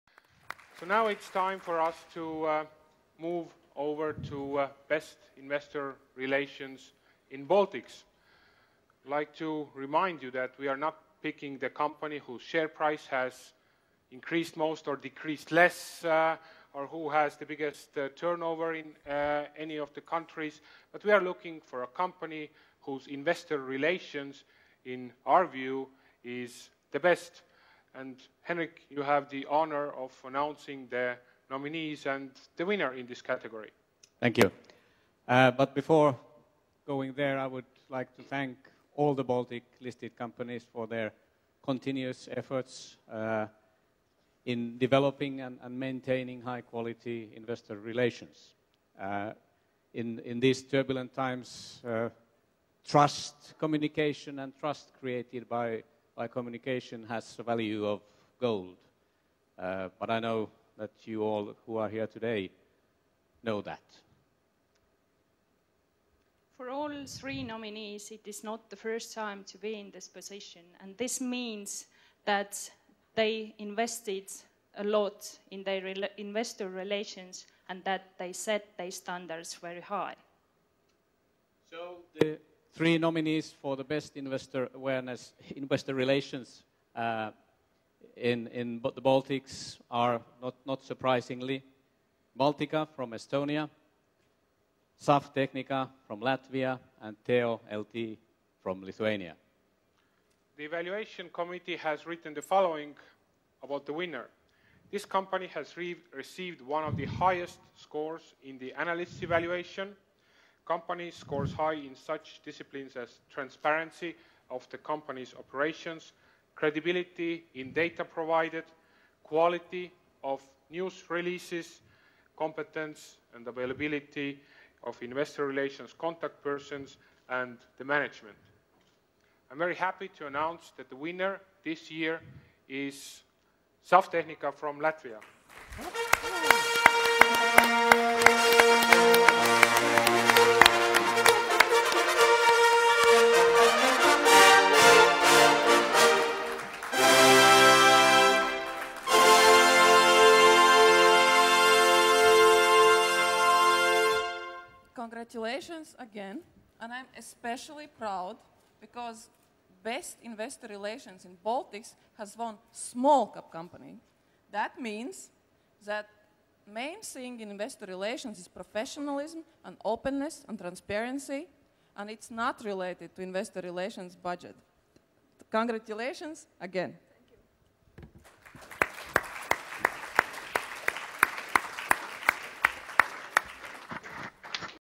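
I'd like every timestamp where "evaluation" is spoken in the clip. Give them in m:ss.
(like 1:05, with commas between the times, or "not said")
1:40, 1:49.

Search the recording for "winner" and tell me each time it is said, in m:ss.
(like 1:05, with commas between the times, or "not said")
0:32, 1:43, 2:10.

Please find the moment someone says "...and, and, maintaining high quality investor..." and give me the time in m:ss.
0:45.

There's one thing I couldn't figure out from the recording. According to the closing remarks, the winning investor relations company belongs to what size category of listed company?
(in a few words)
Small Cap.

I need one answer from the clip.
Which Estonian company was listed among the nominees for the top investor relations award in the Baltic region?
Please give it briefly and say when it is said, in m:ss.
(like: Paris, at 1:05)
Baltika, at 1:32.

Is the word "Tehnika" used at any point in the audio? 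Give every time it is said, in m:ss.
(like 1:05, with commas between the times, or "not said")
1:35, 2:14.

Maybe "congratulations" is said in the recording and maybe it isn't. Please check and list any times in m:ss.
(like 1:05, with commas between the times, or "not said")
2:35, 2:55.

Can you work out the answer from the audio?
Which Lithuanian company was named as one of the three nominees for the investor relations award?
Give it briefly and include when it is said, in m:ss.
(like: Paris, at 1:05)
Teo LT, at 1:37.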